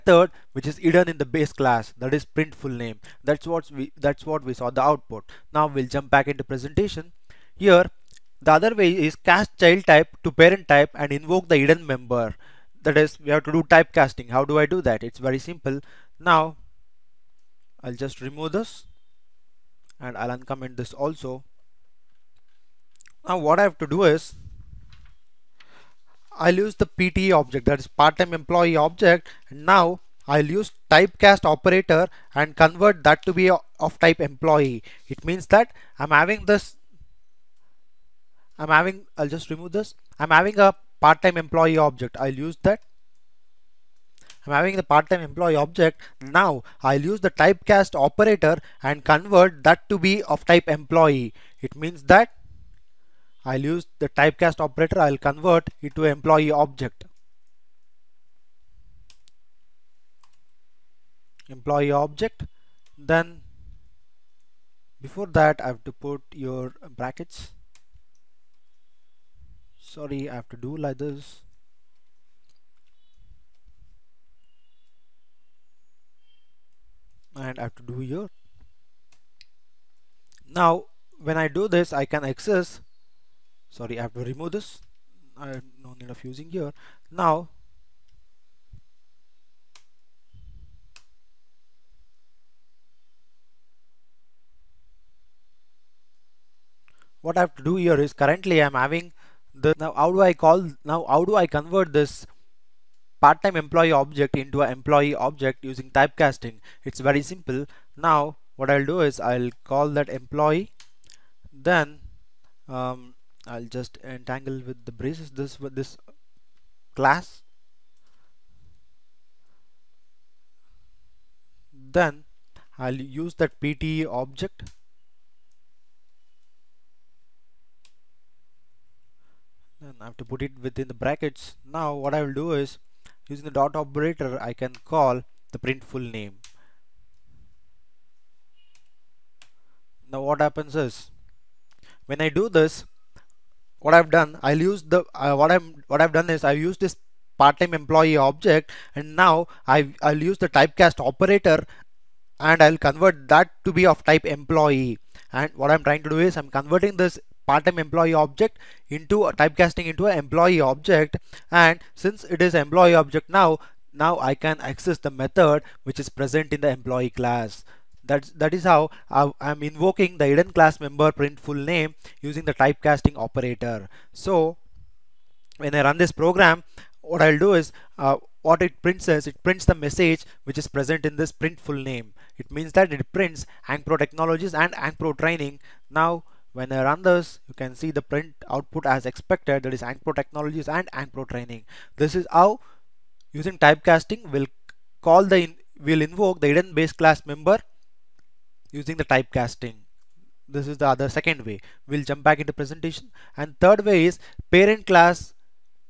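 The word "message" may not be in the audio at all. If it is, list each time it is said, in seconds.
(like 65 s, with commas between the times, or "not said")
179 s.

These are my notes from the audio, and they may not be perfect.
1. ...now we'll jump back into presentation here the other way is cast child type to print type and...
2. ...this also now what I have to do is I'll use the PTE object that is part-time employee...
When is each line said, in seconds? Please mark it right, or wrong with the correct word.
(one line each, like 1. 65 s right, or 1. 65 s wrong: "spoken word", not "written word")
1. 5 s wrong: "parent", not "print"
2. 20 s right.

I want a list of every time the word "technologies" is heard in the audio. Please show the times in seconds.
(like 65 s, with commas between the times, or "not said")
183 s, 190 s.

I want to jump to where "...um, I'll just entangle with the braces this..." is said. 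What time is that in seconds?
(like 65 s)
112 s.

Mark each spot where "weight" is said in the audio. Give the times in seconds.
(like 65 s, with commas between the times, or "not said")
not said.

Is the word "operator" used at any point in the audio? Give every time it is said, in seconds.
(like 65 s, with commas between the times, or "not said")
31 s, 48 s, 54 s, 133 s, 151 s, 173 s.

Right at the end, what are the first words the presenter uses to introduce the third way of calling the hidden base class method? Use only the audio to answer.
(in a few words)
parent class.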